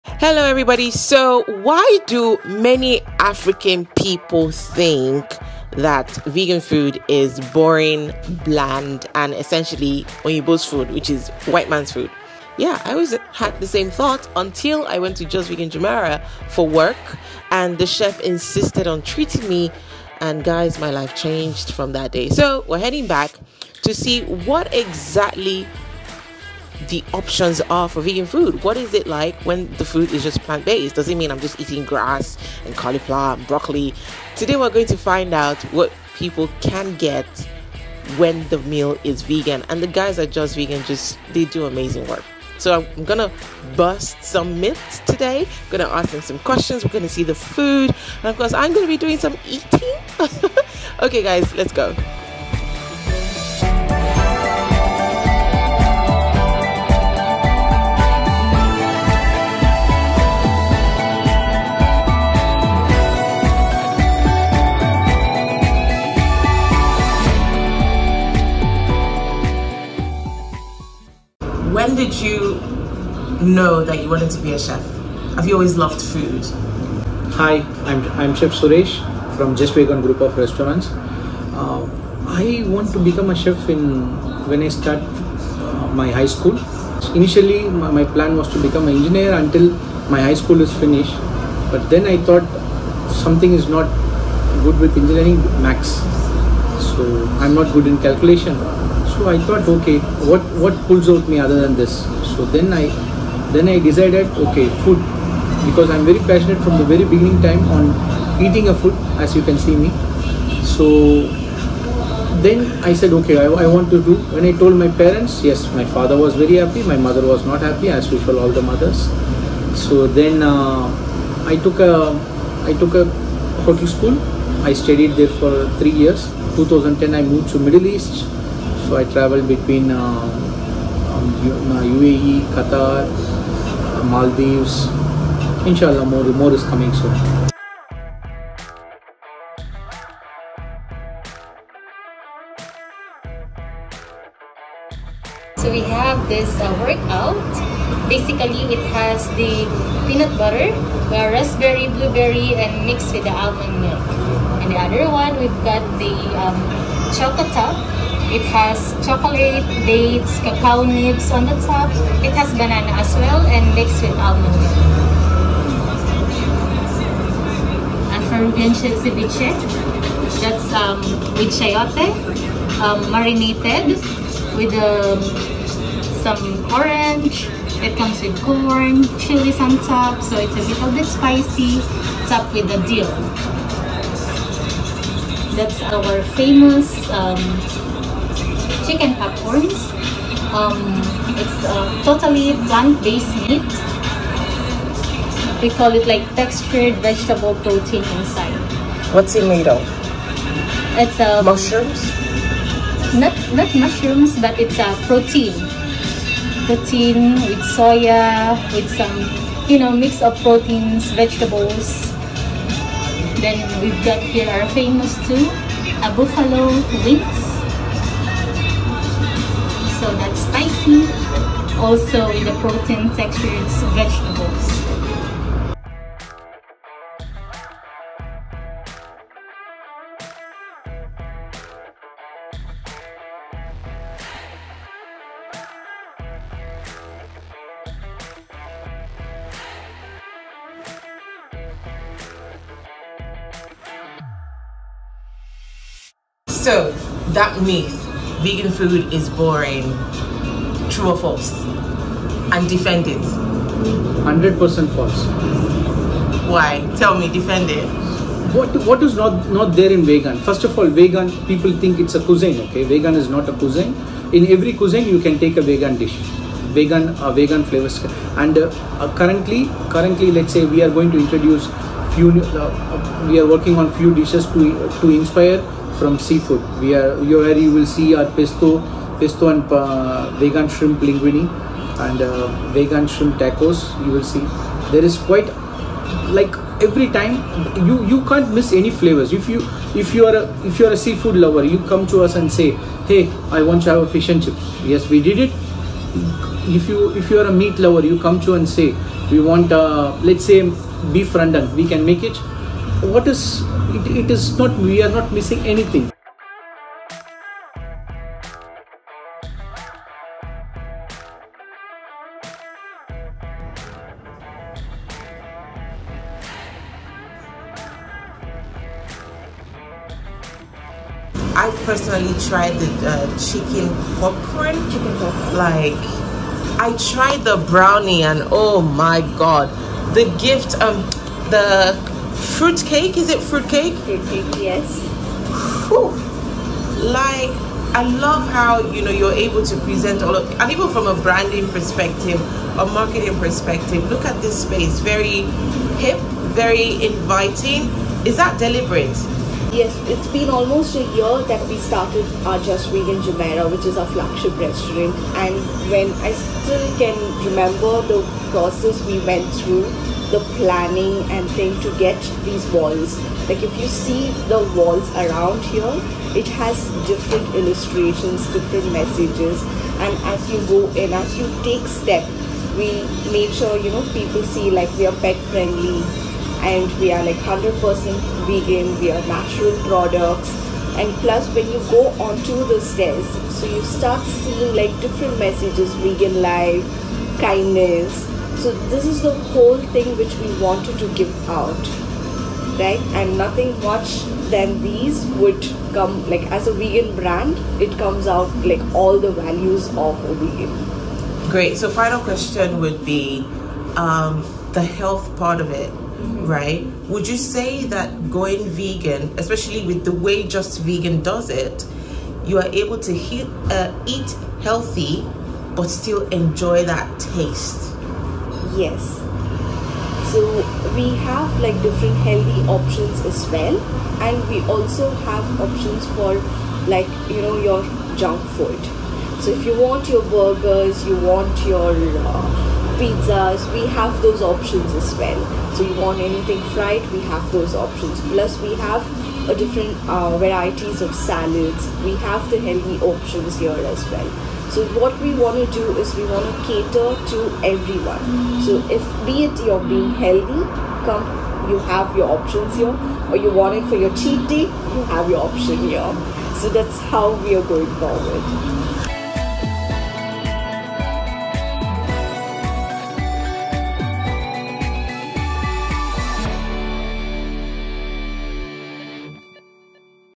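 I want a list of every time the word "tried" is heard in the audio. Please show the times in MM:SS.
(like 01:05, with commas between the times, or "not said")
05:22, 05:27.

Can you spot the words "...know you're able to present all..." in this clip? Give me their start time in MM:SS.
05:39.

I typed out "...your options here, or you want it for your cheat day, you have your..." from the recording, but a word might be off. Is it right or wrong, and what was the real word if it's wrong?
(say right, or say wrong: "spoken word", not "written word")
right.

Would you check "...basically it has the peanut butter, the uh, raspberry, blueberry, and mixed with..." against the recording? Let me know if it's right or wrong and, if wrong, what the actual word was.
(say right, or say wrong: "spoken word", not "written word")
right.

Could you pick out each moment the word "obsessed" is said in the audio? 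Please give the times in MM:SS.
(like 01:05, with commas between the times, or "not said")
not said.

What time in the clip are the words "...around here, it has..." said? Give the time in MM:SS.
06:05.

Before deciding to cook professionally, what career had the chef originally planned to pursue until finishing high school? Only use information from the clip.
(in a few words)
Engineer.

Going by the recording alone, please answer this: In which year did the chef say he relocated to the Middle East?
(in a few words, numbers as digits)
2010.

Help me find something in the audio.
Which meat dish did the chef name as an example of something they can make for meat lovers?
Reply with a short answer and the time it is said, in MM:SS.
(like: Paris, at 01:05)
Beef rendang, at 05:01.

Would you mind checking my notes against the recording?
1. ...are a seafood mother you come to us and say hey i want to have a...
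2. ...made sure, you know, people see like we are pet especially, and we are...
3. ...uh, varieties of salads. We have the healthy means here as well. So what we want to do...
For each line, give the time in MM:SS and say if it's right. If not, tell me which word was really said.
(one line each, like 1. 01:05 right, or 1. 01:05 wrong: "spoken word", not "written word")
1. 04:50 wrong: "lover", not "mother"
2. 06:13 wrong: "friendly", not "especially"
3. 07:20 wrong: "options", not "means".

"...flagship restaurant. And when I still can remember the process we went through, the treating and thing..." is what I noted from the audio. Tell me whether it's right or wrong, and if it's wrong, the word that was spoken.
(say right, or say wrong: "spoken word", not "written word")
wrong: "planning", not "treating".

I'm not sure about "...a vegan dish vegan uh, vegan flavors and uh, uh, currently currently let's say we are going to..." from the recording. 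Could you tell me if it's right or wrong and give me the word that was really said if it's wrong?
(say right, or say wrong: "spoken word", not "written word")
right.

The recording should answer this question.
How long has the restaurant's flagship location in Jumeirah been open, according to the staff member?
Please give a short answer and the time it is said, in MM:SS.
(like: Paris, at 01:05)
Almost a year, at 05:50.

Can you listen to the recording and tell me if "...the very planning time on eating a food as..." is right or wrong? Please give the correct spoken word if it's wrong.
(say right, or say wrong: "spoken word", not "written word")
wrong: "beginning", not "planning".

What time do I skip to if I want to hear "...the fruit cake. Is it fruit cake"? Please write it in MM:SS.
05:31.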